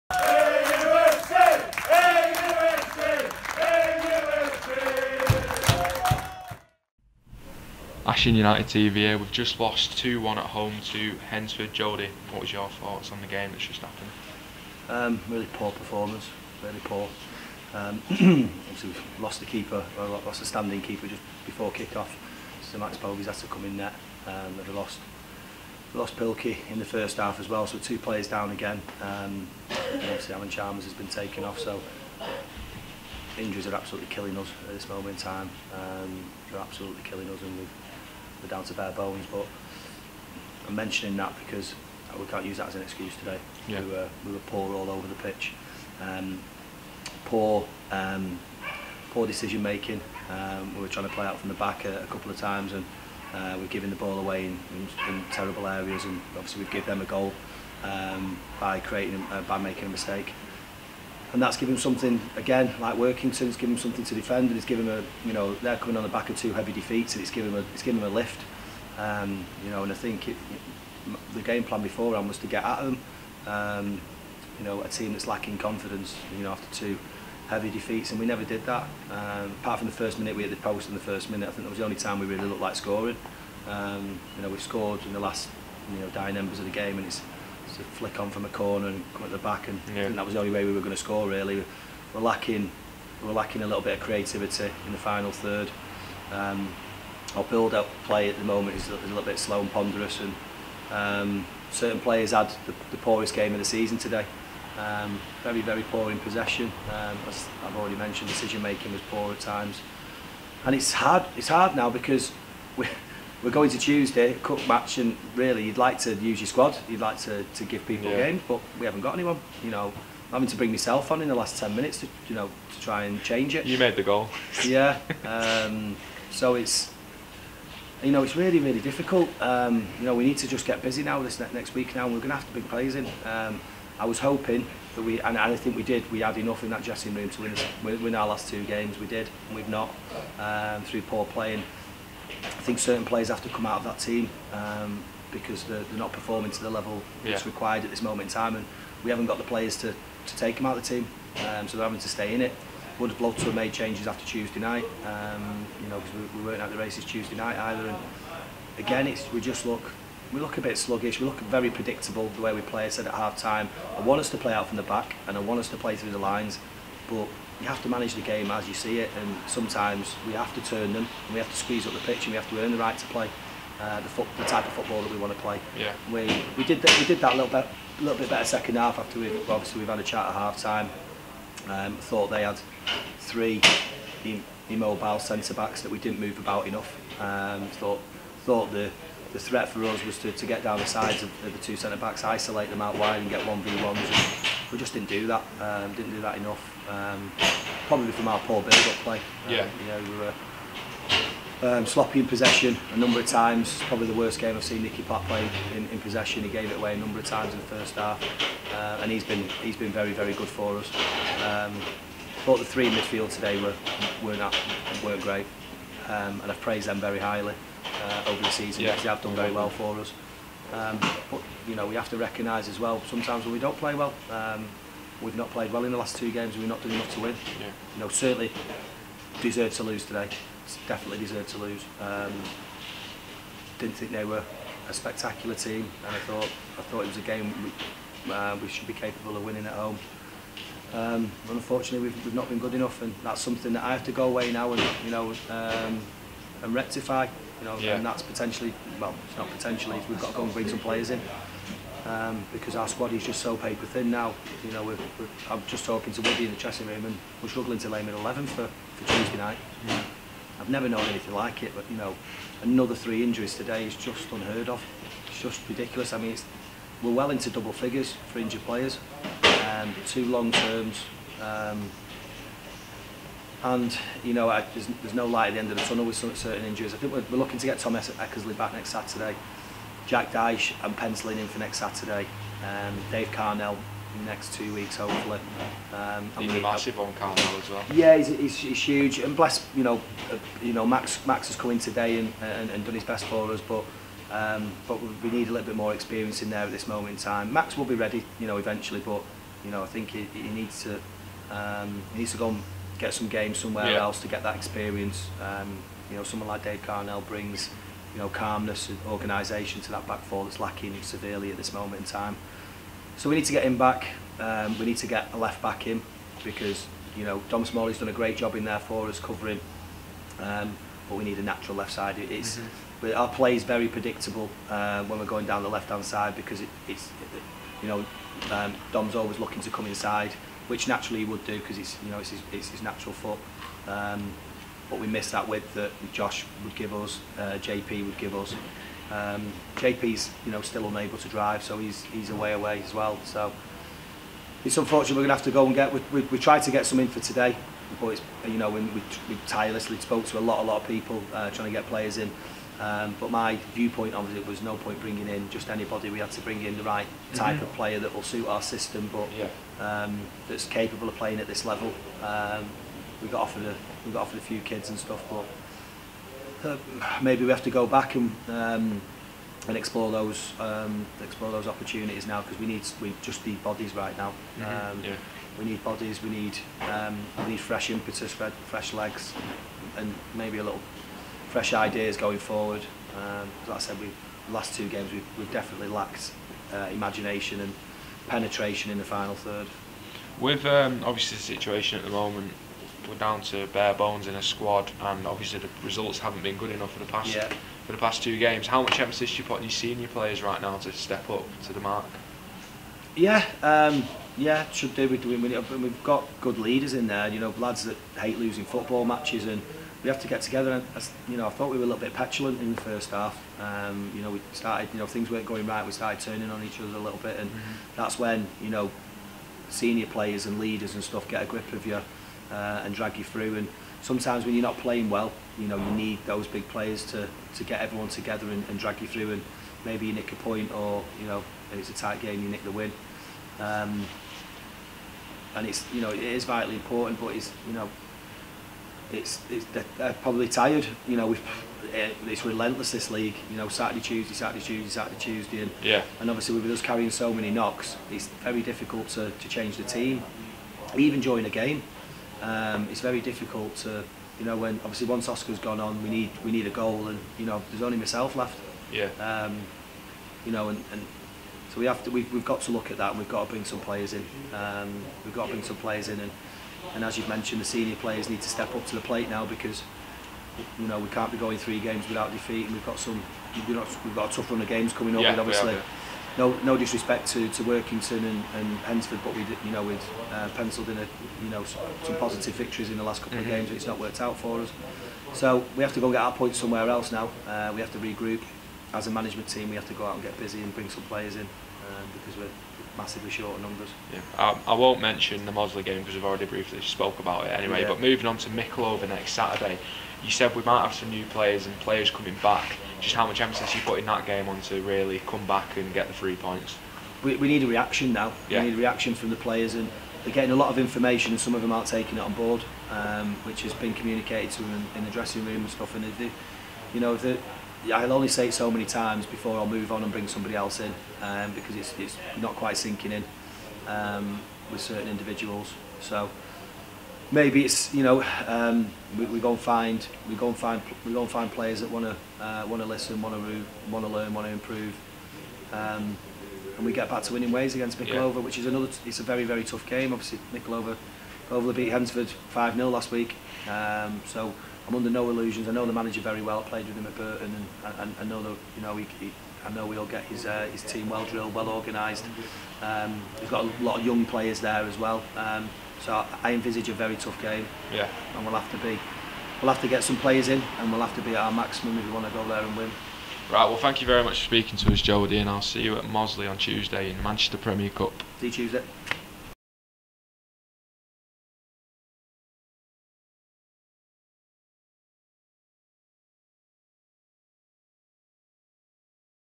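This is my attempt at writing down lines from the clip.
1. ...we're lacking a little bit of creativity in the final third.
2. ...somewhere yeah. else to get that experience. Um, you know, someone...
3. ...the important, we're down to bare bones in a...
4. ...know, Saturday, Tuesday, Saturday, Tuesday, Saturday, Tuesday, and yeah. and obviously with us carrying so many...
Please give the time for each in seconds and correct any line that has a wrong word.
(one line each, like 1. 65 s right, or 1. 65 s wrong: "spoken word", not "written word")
1. 93 s right
2. 303 s right
3. 392 s wrong: "moment", not "important"
4. 443 s right.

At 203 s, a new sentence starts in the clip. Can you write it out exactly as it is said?
Probably the worst game I've seen Nicky Pat play in, in possession.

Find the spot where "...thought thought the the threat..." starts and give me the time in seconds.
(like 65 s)
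187 s.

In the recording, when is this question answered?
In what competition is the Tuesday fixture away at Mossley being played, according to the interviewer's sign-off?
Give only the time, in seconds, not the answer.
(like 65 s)
567 s.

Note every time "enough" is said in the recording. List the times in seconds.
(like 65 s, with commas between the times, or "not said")
136 s, 186 s, 196 s, 226 s, 242 s, 396 s.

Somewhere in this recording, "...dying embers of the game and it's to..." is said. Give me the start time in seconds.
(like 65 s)
86 s.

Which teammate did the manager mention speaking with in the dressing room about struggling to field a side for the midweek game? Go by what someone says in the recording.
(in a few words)
Woody.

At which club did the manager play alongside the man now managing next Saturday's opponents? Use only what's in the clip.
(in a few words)
Burton.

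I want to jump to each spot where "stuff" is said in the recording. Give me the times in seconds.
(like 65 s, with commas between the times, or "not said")
364 s, 421 s, 515 s.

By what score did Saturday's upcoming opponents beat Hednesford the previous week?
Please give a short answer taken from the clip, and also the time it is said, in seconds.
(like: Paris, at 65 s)
5-0, at 542 s.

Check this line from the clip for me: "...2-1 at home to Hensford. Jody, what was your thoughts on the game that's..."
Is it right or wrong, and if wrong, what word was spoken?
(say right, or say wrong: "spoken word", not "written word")
right.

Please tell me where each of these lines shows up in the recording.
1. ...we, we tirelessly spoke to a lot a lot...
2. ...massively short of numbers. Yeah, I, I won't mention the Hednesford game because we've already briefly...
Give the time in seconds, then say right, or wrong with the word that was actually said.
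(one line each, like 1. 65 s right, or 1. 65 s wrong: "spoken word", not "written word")
1. 348 s right
2. 492 s wrong: "Mossley", not "Hednesford".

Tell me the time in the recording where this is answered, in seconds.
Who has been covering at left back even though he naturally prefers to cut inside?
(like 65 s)
317 s.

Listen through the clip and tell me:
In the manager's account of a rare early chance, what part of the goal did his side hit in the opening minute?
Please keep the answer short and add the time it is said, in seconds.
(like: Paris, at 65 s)
The post, at 80 s.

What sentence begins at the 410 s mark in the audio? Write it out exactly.
And I, you know, I thought we were a little bit petulant in the first half.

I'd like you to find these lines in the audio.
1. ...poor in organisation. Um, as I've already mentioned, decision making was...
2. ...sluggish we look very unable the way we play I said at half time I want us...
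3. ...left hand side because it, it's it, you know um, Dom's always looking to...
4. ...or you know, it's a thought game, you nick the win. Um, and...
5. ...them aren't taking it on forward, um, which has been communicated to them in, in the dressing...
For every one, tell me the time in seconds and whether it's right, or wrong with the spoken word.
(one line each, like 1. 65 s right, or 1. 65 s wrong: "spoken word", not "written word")
1. 105 s wrong: "possession", not "organisation"
2. 160 s wrong: "predictable", not "unable"
3. 325 s right
4. 430 s wrong: "tight", not "thought"
5. 511 s wrong: "board", not "forward".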